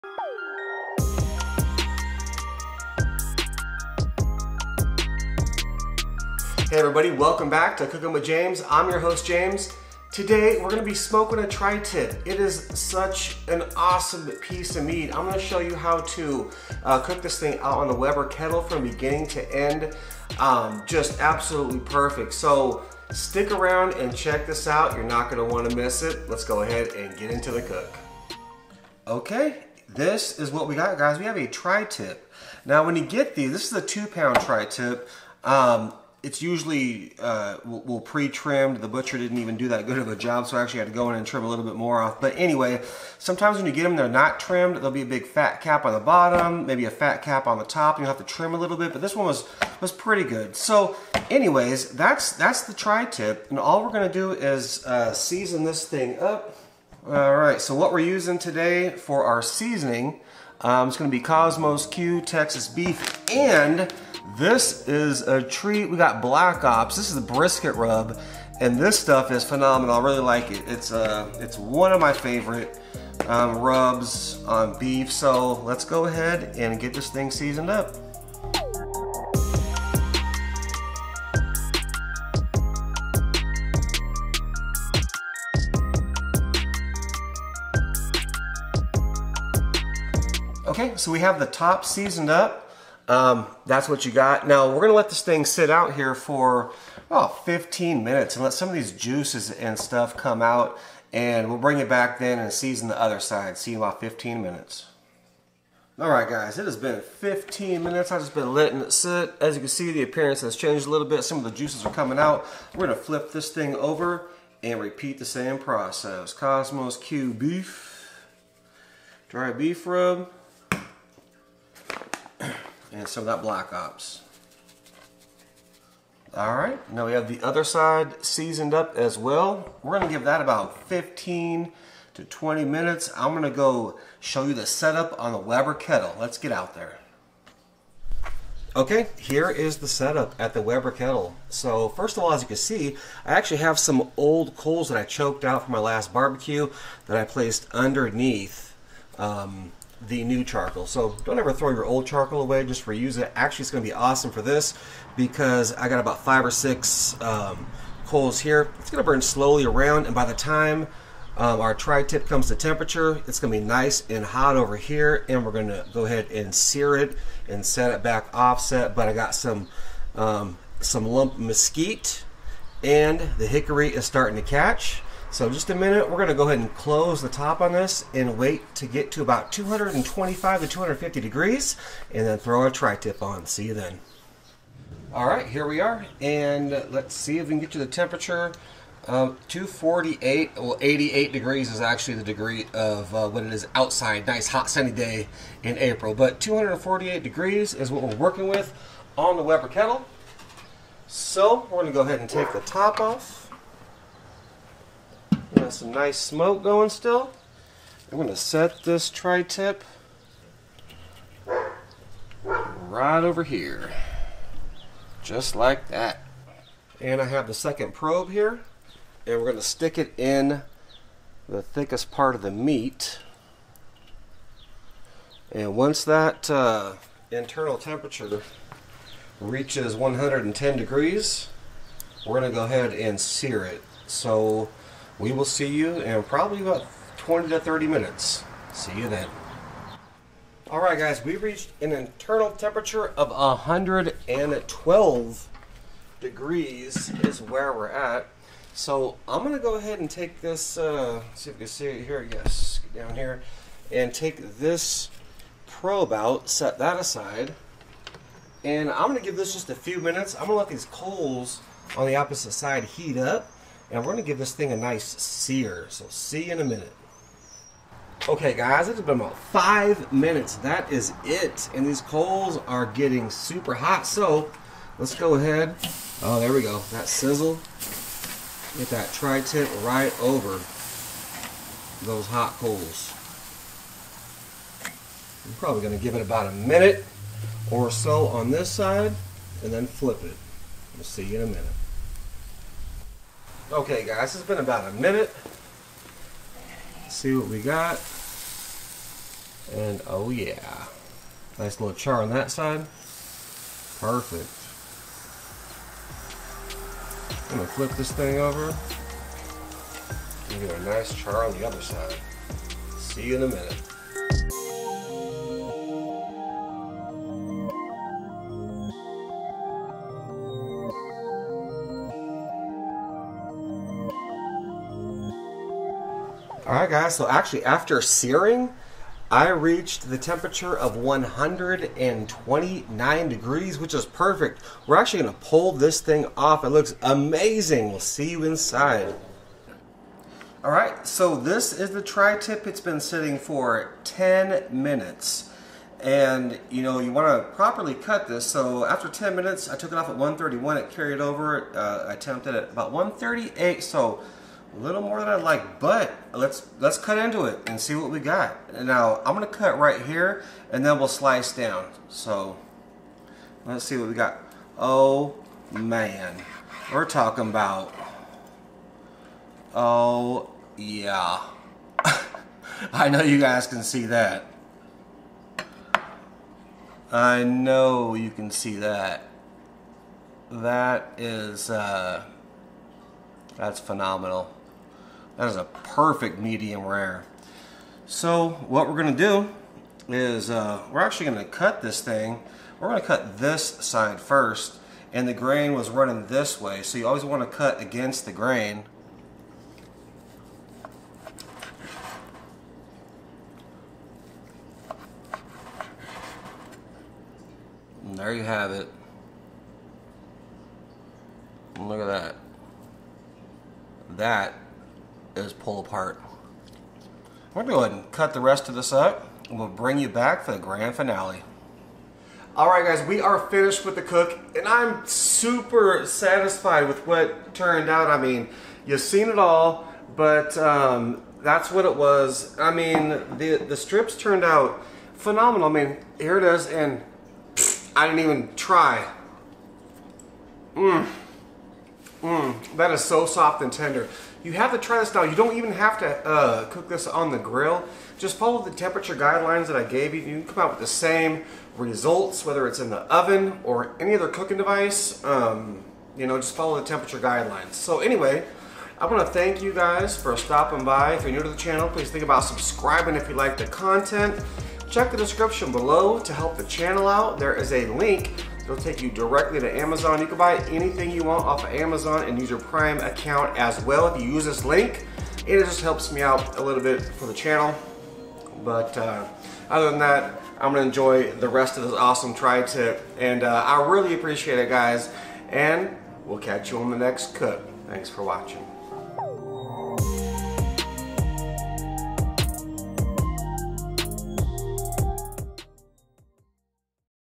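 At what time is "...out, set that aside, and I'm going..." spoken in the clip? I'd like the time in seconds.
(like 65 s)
256 s.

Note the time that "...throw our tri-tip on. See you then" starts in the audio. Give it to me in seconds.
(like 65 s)
182 s.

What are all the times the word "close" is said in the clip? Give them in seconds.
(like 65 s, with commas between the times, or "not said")
176 s.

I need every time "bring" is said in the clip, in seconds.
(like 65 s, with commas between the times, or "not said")
101 s, 419 s.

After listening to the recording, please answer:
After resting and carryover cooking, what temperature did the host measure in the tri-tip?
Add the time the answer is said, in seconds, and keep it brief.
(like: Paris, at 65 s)
138, at 352 s.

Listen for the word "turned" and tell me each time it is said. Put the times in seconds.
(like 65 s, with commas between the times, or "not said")
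427 s, 434 s.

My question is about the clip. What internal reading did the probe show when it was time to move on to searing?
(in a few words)
112 degrees.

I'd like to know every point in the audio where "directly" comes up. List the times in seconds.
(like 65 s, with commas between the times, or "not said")
469 s.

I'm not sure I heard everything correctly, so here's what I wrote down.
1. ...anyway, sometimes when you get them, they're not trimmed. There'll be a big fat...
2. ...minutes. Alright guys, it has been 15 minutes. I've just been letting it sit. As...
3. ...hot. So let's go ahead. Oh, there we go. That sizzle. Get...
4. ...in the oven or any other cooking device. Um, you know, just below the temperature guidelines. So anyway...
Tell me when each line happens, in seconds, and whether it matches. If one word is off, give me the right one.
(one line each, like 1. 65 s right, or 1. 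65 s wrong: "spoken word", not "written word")
1. 42 s right
2. 104 s right
3. 273 s right
4. 452 s wrong: "follow", not "below".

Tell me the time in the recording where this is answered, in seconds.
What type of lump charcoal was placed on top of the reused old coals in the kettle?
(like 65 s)
171 s.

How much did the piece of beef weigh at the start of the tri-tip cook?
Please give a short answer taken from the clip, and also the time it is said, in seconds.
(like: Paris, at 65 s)
2 pounds, at 33 s.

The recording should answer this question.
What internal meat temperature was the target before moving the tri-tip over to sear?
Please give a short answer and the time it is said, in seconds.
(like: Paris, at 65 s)
110 degrees, at 229 s.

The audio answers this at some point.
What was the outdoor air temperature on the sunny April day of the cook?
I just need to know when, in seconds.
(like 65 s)
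190 s.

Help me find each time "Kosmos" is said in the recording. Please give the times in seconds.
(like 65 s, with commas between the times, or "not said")
61 s, 116 s.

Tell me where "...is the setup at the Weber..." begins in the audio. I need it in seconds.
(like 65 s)
139 s.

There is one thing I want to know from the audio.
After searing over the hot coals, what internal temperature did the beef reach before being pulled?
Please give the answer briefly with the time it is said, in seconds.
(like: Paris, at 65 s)
129 degrees, at 330 s.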